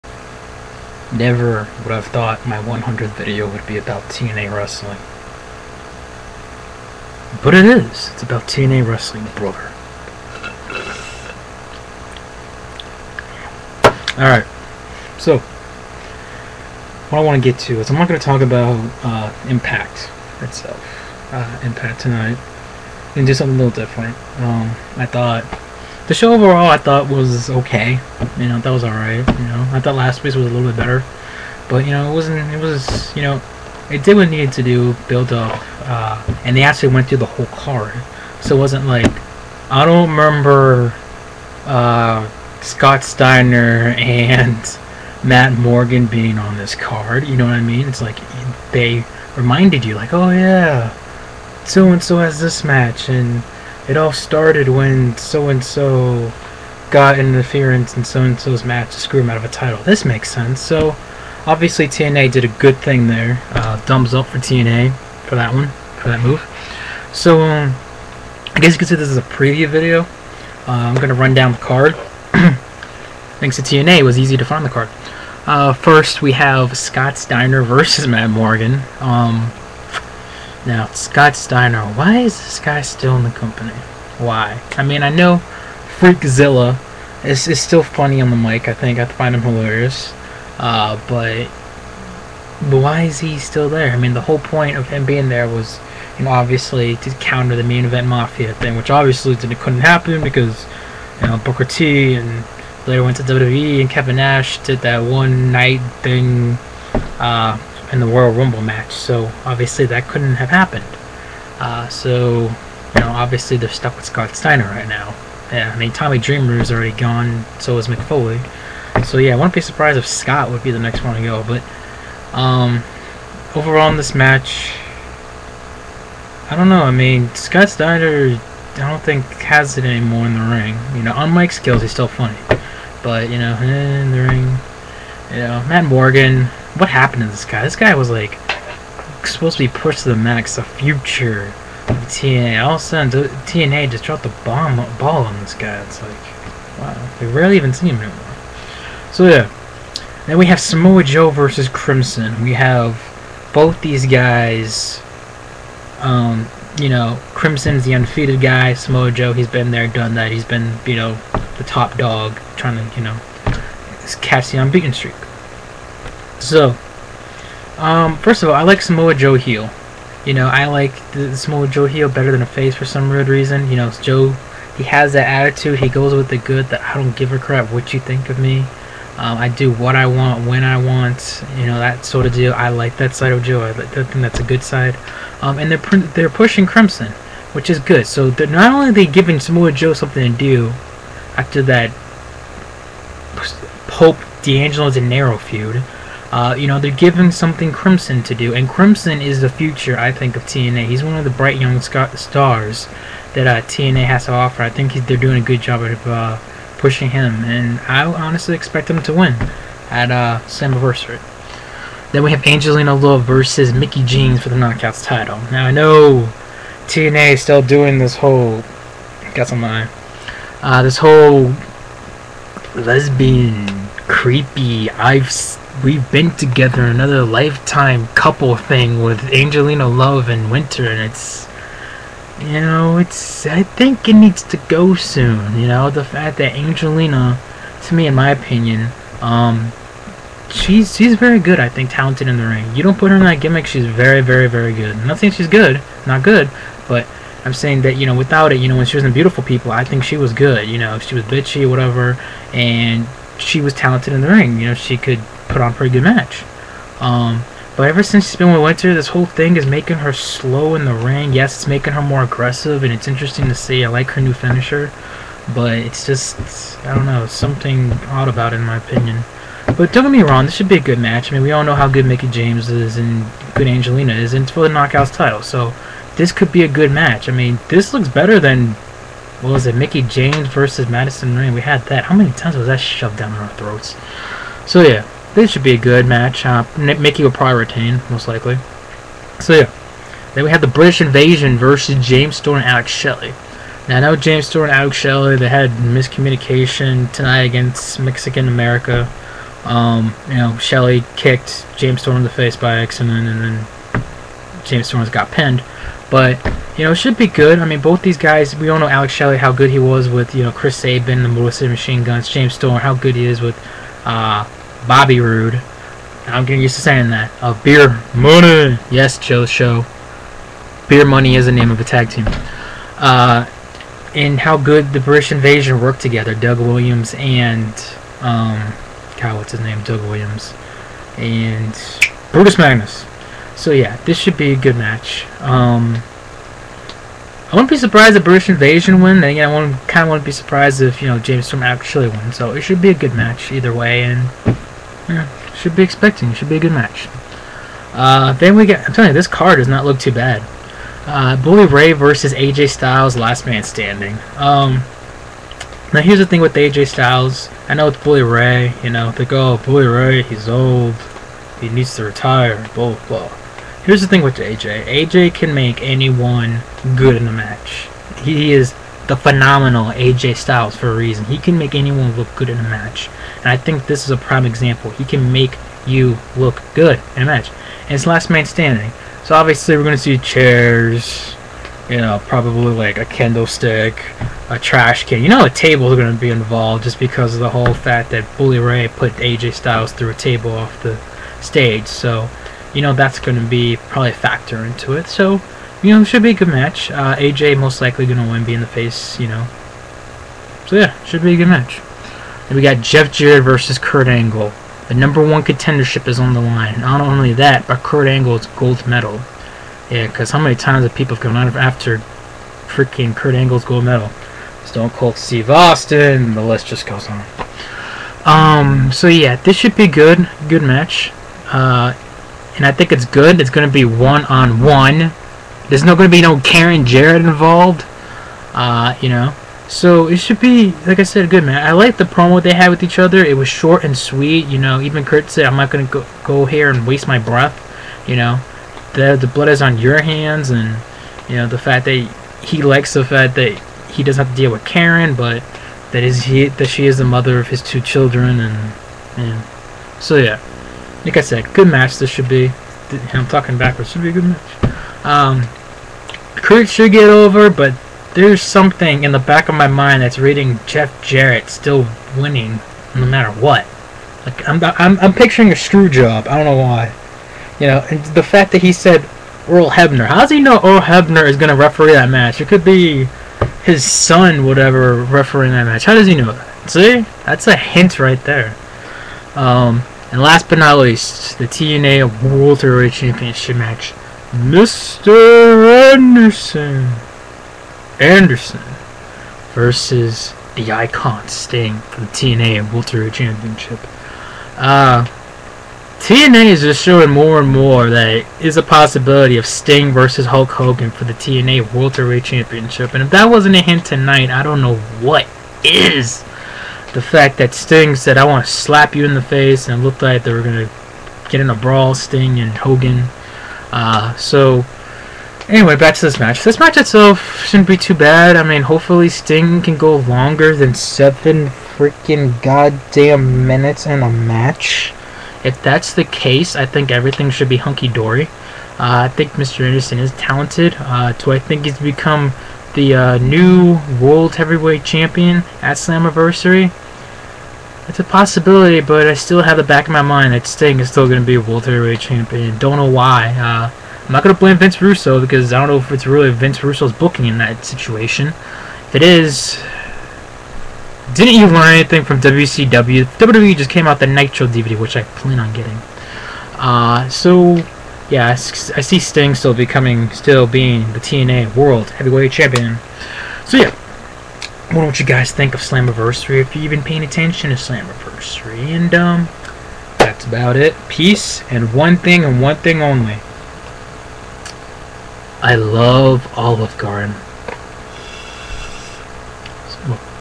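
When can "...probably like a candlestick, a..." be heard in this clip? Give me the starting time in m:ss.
6:22.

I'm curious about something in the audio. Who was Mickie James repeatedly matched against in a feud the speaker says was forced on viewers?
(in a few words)
Madison Rayne.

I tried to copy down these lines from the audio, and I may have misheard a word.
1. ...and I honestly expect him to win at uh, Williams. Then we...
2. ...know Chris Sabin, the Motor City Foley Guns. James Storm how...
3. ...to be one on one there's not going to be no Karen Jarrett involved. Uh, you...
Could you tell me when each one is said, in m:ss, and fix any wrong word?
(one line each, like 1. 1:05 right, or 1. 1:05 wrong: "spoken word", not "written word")
1. 3:27 wrong: "Slammiversary", not "Williams"
2. 5:10 wrong: "Machine", not "Foley"
3. 7:03 right.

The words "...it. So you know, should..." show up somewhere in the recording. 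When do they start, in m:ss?
6:34.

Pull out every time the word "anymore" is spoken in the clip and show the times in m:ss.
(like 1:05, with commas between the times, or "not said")
2:09, 2:27.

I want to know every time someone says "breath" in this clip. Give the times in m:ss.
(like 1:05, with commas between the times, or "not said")
7:17.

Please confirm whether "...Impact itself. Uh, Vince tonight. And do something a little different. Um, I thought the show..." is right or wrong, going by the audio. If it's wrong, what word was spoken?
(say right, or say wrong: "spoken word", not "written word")
wrong: "Impact", not "Vince".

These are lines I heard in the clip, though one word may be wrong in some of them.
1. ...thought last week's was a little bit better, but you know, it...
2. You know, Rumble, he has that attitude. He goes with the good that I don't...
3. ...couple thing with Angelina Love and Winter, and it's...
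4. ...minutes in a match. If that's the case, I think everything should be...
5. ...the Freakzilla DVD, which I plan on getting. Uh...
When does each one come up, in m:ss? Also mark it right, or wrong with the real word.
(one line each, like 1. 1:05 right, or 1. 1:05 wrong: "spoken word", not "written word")
1. 0:29 right
2. 2:53 wrong: "Joe", not "Rumble"
3. 3:48 right
4. 8:43 right
5. 9:13 wrong: "Nitro", not "Freakzilla".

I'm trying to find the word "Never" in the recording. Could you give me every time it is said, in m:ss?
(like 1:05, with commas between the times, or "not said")
0:01.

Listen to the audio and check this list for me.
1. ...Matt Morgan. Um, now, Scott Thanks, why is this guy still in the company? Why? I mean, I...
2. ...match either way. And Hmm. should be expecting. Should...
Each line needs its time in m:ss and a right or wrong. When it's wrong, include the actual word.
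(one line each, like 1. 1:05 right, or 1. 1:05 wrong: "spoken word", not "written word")
1. 1:18 wrong: "Steiner", not "Thanks"
2. 5:43 right.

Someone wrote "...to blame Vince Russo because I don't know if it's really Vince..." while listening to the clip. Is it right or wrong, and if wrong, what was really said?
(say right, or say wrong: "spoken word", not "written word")
right.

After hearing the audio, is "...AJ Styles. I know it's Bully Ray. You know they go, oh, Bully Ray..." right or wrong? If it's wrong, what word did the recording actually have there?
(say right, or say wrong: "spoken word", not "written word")
right.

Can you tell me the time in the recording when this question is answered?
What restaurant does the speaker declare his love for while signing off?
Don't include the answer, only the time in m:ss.
9:36.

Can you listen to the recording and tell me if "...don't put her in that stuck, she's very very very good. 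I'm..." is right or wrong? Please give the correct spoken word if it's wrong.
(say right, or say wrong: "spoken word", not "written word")
wrong: "gimmick", not "stuck".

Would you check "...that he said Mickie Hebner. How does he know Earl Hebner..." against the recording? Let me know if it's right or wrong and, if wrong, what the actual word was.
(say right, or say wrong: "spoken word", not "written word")
wrong: "Earl", not "Mickie".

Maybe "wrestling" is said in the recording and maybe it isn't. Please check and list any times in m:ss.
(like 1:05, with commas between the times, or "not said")
0:04, 0:08.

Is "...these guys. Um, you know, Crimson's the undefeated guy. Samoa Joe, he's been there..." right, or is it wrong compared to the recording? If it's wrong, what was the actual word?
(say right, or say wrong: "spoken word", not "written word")
right.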